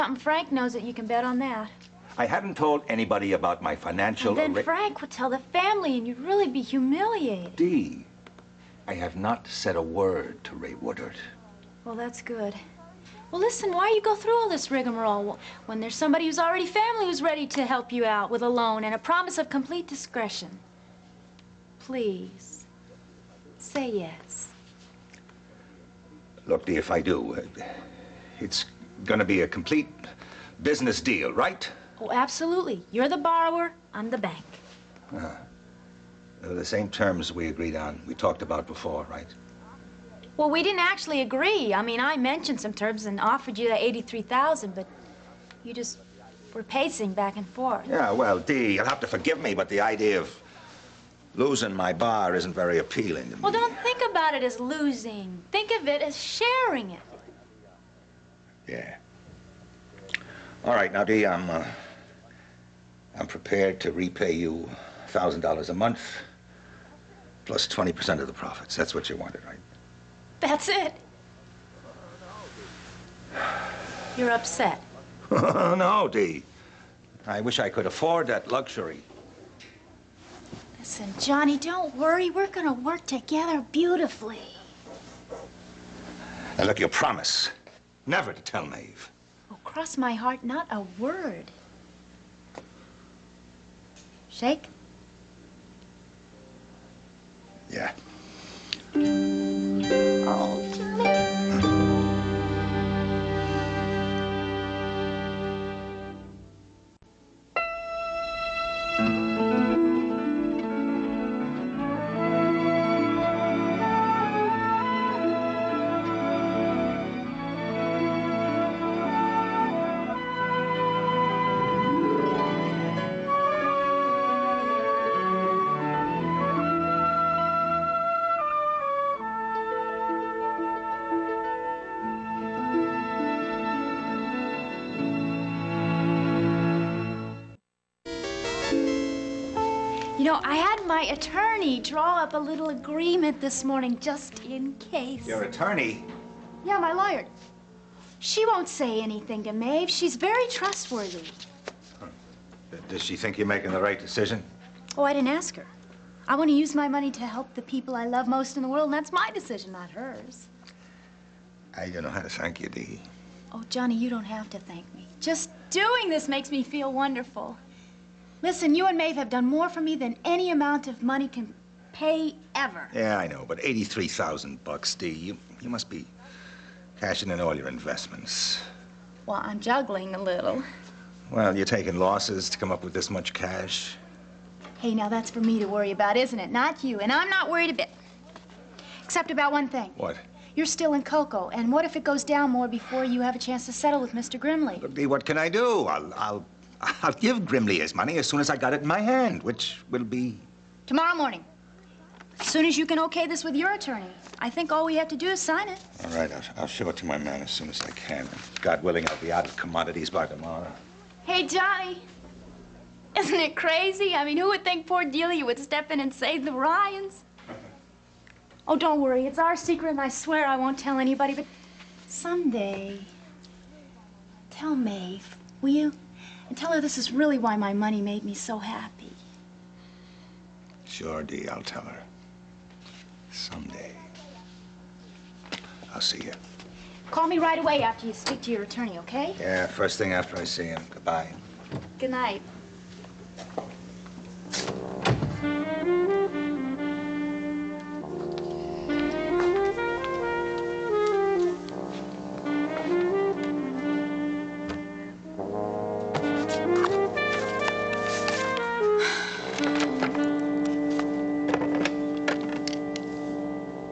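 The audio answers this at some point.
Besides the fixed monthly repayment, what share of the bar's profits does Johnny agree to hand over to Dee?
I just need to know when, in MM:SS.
01:07.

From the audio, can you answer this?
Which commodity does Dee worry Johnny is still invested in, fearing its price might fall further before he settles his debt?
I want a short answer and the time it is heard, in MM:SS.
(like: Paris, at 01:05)
Cocoa, at 03:11.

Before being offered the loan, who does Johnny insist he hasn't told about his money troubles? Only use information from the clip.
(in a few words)
Rae Woodard.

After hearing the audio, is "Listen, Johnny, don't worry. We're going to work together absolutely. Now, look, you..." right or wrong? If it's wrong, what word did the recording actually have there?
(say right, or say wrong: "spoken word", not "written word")
wrong: "beautifully", not "absolutely".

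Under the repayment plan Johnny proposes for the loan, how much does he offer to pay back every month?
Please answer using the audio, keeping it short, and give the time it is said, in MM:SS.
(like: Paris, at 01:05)
$1,000, at 01:05.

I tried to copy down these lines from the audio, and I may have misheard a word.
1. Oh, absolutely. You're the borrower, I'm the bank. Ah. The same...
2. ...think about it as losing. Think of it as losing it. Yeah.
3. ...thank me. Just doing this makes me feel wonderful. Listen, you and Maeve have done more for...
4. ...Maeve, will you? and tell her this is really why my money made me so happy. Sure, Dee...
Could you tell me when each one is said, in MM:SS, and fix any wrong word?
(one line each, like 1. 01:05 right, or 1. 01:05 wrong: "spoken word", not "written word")
1. 00:32 right
2. 00:53 wrong: "sharing", not "losing"
3. 02:44 right
4. 03:44 right.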